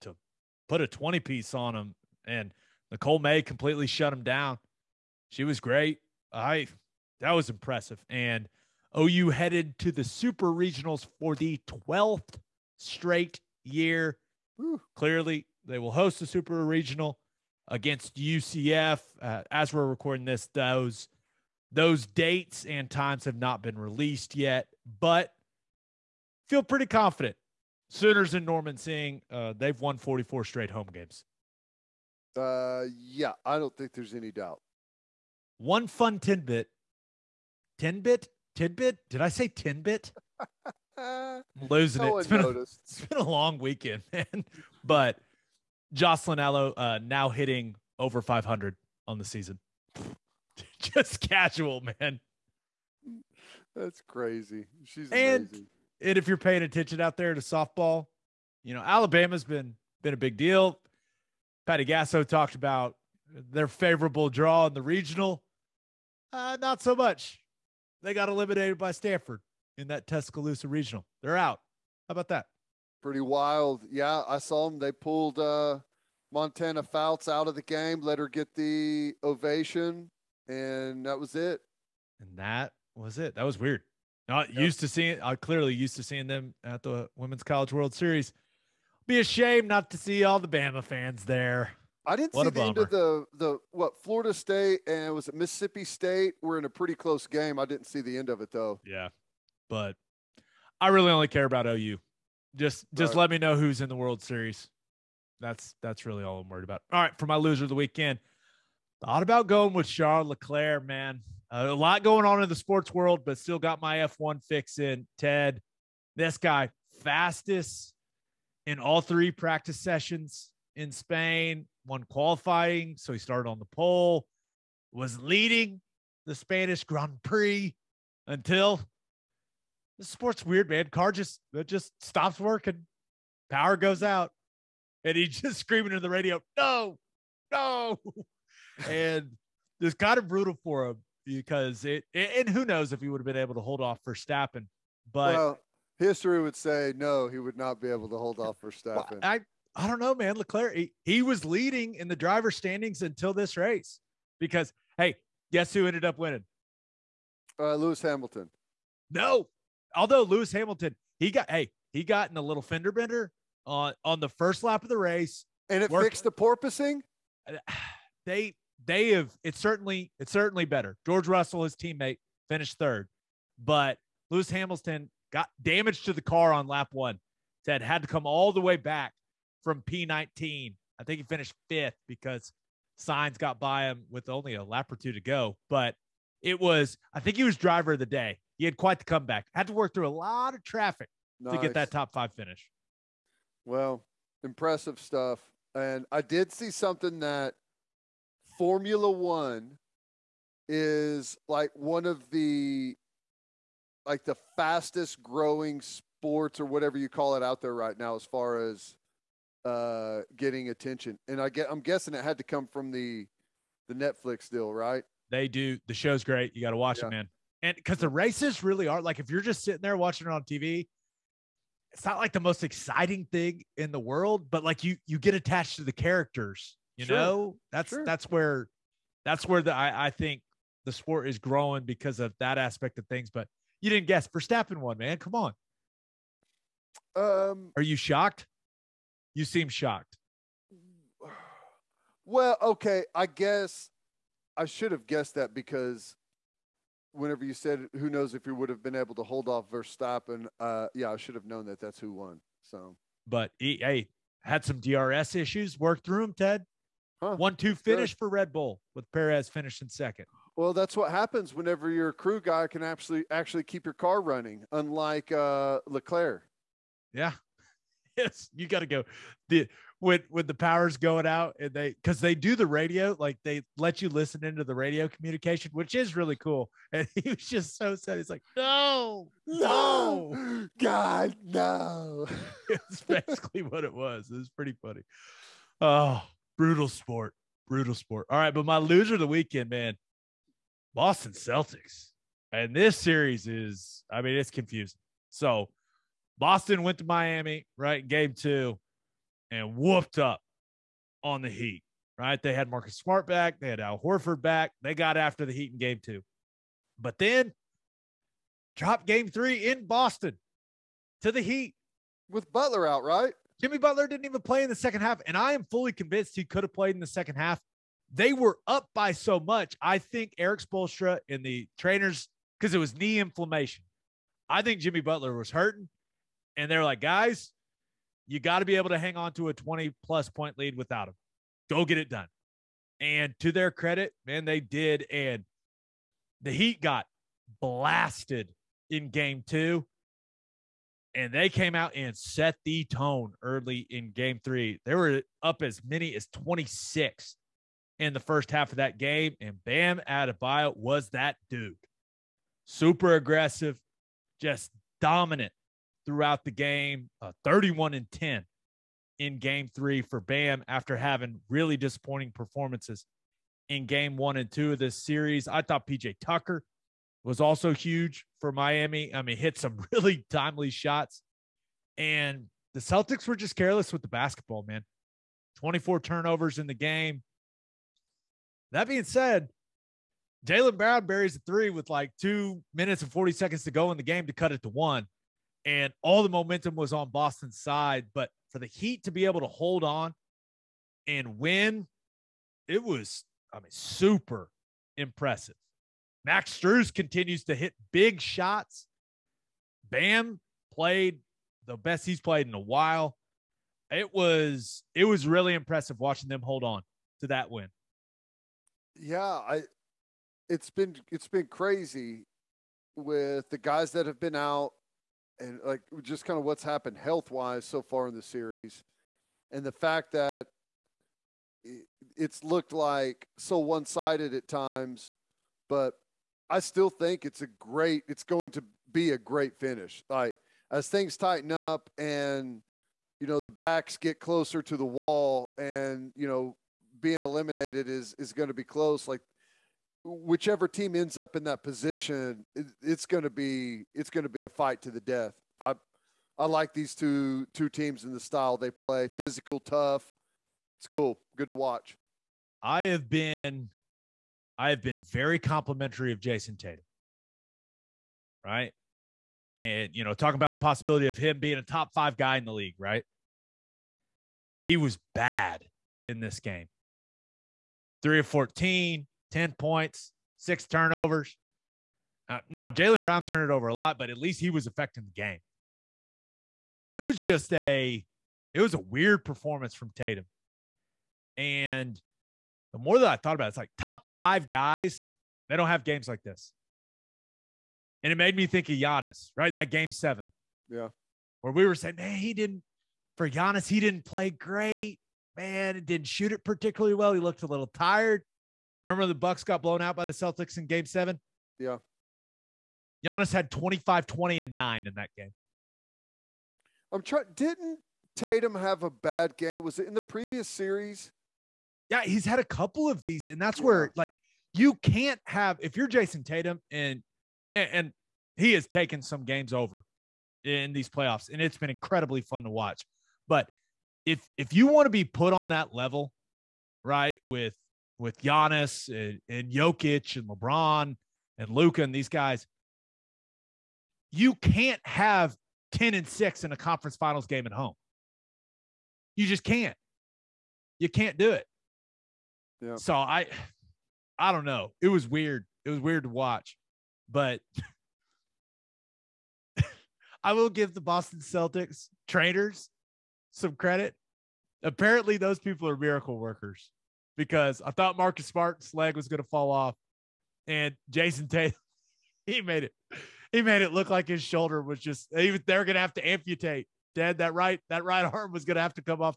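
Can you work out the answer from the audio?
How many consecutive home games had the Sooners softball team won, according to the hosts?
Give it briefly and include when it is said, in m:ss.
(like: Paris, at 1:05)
44, at 0:29.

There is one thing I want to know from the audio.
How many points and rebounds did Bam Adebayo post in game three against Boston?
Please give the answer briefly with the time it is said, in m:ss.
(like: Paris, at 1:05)
31 and 10, at 5:57.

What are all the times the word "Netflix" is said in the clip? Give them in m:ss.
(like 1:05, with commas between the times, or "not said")
3:33.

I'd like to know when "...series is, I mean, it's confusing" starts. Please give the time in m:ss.
4:52.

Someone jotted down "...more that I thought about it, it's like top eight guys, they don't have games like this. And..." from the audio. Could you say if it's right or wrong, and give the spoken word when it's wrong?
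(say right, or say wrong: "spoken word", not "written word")
wrong: "five", not "eight".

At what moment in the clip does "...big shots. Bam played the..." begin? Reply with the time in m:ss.
6:37.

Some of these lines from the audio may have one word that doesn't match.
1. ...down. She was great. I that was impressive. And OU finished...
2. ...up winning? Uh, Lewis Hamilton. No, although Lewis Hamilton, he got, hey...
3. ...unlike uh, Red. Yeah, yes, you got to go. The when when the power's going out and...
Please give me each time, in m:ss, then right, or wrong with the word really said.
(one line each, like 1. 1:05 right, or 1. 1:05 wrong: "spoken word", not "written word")
1. 0:04 wrong: "headed", not "finished"
2. 2:36 right
3. 4:24 wrong: "Leclerc", not "Red".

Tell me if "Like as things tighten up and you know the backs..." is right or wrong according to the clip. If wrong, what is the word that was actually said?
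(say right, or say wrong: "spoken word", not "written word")
right.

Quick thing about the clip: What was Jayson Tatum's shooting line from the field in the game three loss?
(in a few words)
3 of 14.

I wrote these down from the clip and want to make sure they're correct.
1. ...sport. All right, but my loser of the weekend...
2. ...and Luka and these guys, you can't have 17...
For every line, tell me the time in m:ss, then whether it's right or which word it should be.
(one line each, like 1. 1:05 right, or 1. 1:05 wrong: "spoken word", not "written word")
1. 4:47 right
2. 8:51 wrong: "10", not "17".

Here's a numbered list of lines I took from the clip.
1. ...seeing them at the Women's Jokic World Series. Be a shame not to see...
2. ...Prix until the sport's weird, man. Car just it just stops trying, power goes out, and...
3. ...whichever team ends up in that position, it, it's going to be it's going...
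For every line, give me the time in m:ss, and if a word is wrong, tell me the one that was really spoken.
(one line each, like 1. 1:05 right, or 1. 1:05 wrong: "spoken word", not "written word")
1. 1:26 wrong: "College", not "Jokic"
2. 2:07 wrong: "working", not "trying"
3. 7:20 right.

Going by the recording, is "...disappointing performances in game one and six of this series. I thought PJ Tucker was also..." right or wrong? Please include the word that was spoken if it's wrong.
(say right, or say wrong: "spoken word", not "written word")
wrong: "two", not "six".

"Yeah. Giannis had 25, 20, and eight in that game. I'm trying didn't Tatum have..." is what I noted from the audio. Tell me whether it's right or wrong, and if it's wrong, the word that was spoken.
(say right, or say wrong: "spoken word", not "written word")
wrong: "nine", not "eight".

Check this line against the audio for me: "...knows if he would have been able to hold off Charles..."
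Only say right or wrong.
wrong.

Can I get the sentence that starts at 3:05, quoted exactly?
But it was, I think he was driver of the day.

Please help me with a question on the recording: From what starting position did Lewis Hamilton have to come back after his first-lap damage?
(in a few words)
P19.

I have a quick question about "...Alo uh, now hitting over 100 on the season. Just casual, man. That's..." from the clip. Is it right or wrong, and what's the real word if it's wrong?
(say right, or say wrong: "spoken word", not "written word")
wrong: "500", not "100".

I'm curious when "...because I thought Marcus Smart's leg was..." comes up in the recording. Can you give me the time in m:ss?
9:17.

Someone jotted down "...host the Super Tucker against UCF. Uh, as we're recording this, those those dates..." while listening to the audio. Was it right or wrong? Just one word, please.
wrong.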